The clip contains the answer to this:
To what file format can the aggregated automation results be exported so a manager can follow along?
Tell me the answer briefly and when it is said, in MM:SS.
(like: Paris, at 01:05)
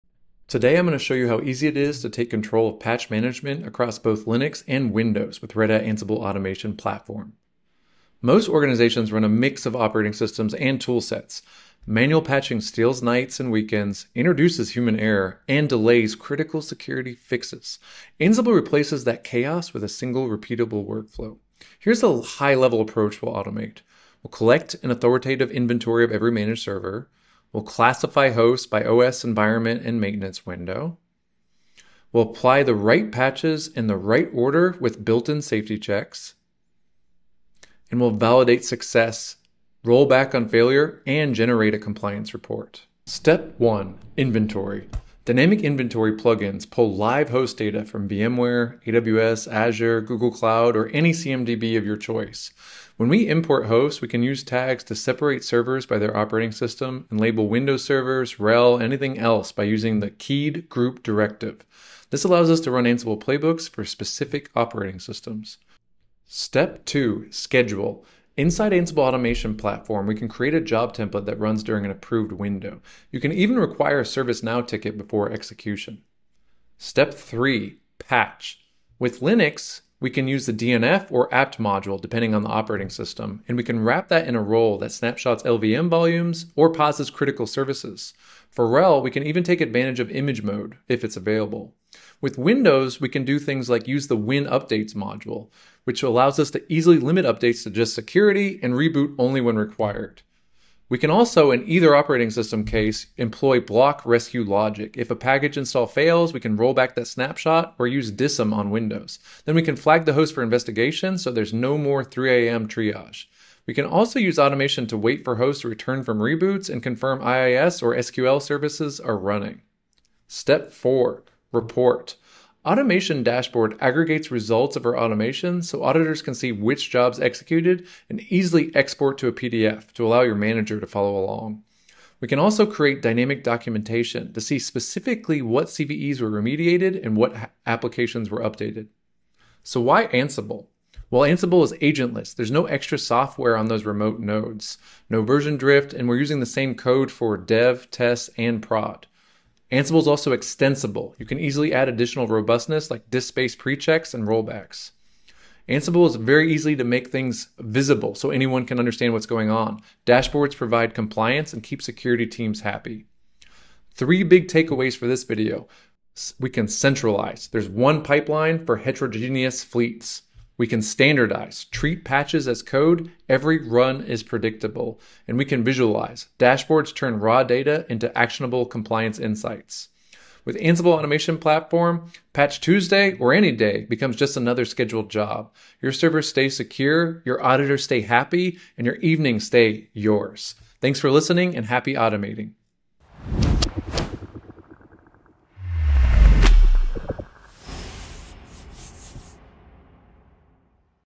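PDF, at 02:09.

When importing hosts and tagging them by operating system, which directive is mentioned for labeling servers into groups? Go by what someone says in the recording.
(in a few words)
keyed group.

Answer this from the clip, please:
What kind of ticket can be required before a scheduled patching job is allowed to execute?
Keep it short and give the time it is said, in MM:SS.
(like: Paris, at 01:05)
ServiceNow ticket, at 01:14.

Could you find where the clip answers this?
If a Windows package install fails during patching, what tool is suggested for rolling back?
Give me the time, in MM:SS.
01:48.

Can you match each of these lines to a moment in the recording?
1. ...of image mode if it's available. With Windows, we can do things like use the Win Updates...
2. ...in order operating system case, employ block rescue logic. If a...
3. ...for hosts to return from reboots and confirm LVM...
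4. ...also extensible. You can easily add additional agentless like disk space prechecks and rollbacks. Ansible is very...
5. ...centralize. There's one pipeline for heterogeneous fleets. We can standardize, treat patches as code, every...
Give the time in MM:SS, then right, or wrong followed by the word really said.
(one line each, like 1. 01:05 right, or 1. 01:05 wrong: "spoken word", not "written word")
1. 01:29 right
2. 01:41 wrong: "either", not "order"
3. 01:55 wrong: "IIS", not "LVM"
4. 02:30 wrong: "robustness", not "agentless"
5. 02:46 right.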